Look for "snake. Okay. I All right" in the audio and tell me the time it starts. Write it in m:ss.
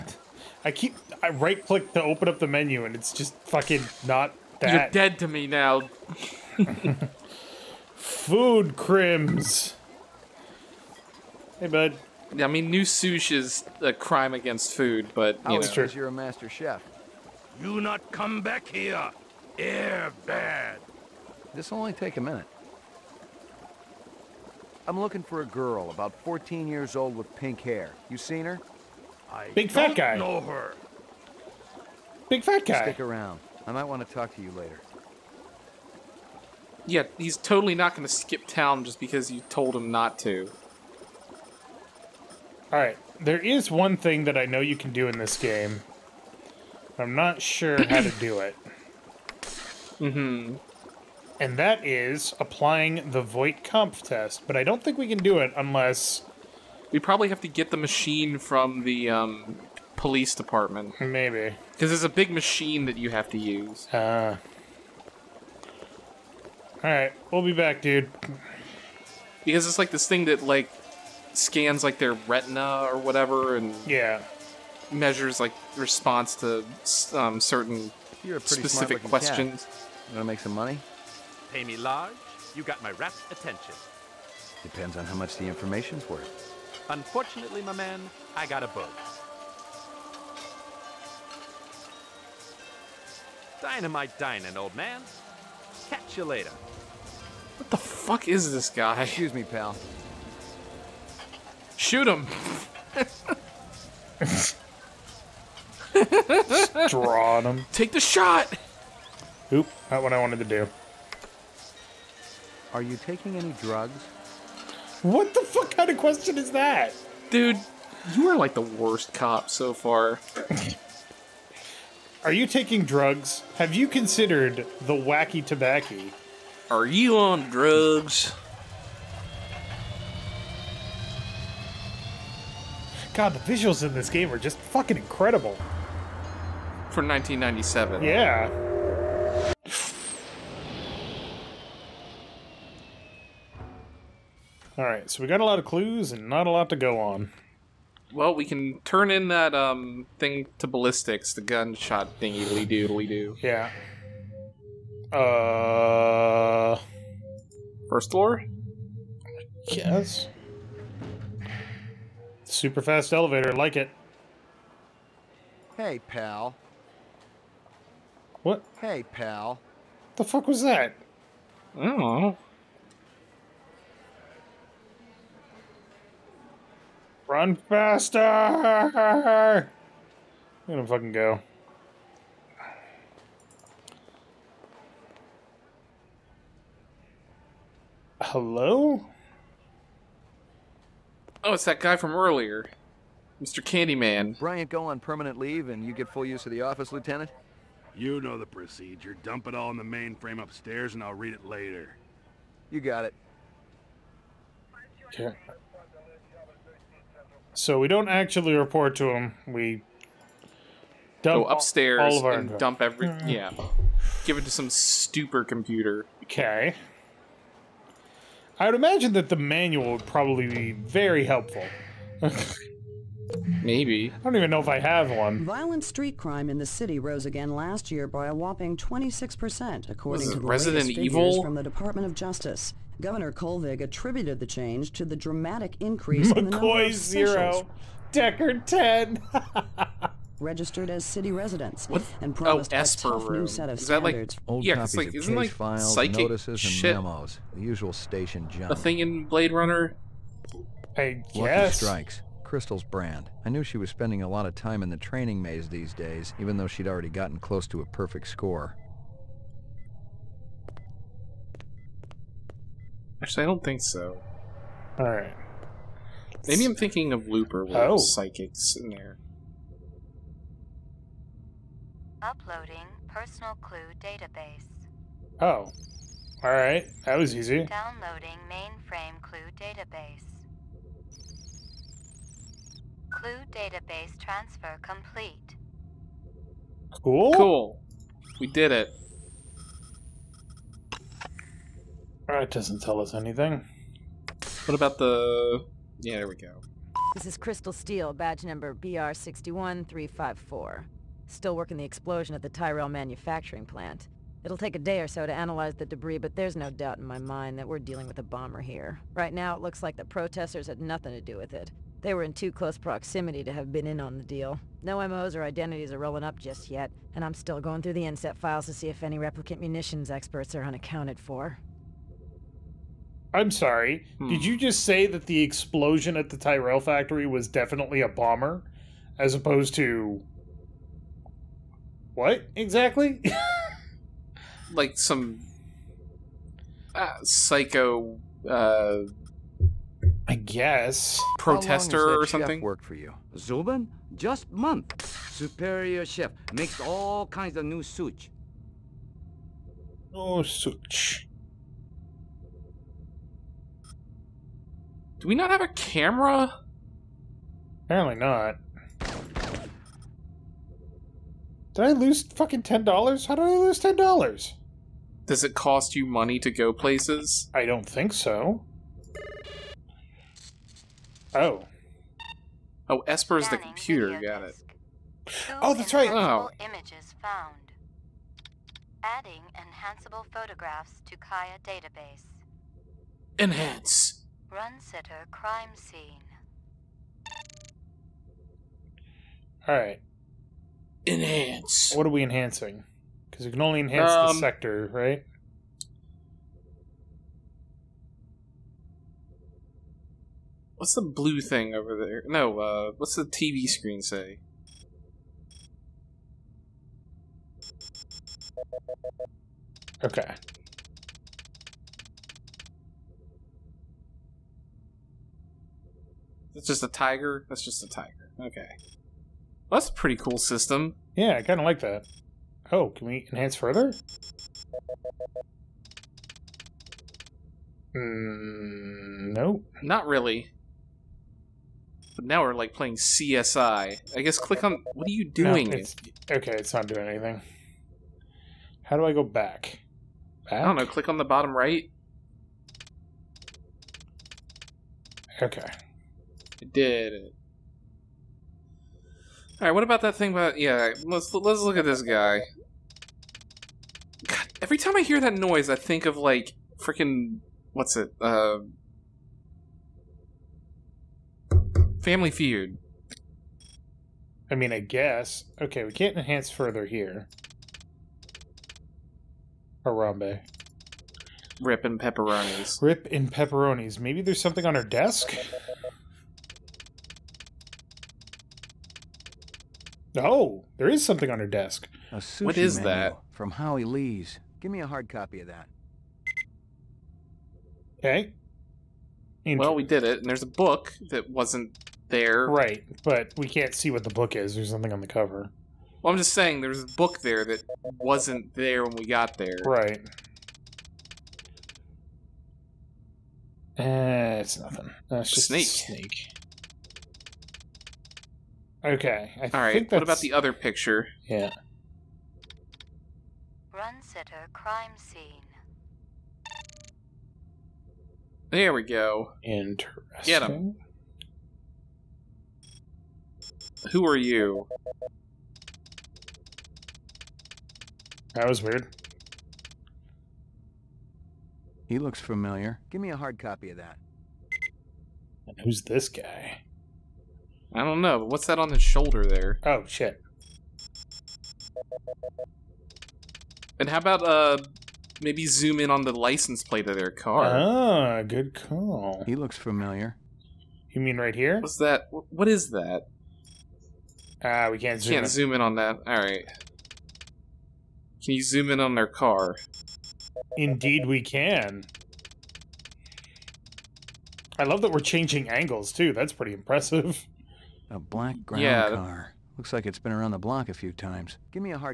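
8:25.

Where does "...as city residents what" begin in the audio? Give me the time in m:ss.
4:00.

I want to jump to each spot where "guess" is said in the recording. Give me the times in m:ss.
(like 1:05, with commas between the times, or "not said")
4:11, 5:40, 7:14, 7:44.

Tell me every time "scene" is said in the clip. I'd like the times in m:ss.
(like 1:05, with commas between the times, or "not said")
6:25, 8:34.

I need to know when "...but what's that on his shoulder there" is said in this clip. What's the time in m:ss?
8:58.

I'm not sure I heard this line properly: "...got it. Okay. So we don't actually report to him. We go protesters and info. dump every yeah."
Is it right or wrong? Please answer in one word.
wrong.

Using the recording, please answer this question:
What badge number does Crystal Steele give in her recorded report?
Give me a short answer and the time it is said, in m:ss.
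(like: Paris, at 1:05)
BR61354, at 4:58.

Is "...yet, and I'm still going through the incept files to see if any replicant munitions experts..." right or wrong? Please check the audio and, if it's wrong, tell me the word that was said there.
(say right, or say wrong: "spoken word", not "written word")
right.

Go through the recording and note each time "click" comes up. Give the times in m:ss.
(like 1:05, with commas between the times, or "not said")
0:01, 7:14, 7:20.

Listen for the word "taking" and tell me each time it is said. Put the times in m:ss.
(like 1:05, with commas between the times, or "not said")
1:53, 2:02.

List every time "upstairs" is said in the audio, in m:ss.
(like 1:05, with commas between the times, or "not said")
3:20, 3:31.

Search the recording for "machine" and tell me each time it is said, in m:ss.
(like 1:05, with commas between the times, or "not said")
0:57, 1:02.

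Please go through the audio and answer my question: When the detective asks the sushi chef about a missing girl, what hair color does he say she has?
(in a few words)
pink.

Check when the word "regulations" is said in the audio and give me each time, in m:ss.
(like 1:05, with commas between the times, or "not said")
not said.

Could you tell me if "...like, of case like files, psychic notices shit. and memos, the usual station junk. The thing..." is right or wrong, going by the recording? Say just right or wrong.
right.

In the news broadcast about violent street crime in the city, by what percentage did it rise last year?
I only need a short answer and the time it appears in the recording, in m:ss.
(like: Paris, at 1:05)
26%, at 3:48.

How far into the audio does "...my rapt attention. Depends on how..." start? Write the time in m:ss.
1:22.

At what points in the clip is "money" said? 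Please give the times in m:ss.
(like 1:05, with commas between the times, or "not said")
1:20, 6:06.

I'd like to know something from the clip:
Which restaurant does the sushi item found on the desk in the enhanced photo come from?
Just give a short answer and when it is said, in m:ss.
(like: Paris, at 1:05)
Howie Lee's, at 8:03.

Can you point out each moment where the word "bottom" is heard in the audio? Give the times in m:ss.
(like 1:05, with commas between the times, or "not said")
7:21.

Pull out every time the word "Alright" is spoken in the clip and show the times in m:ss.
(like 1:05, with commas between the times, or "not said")
1:06, 6:29, 9:16.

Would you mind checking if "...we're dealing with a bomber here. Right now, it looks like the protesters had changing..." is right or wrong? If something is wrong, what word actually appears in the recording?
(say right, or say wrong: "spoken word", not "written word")
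wrong: "nothing", not "changing".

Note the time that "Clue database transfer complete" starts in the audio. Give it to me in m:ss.
4:43.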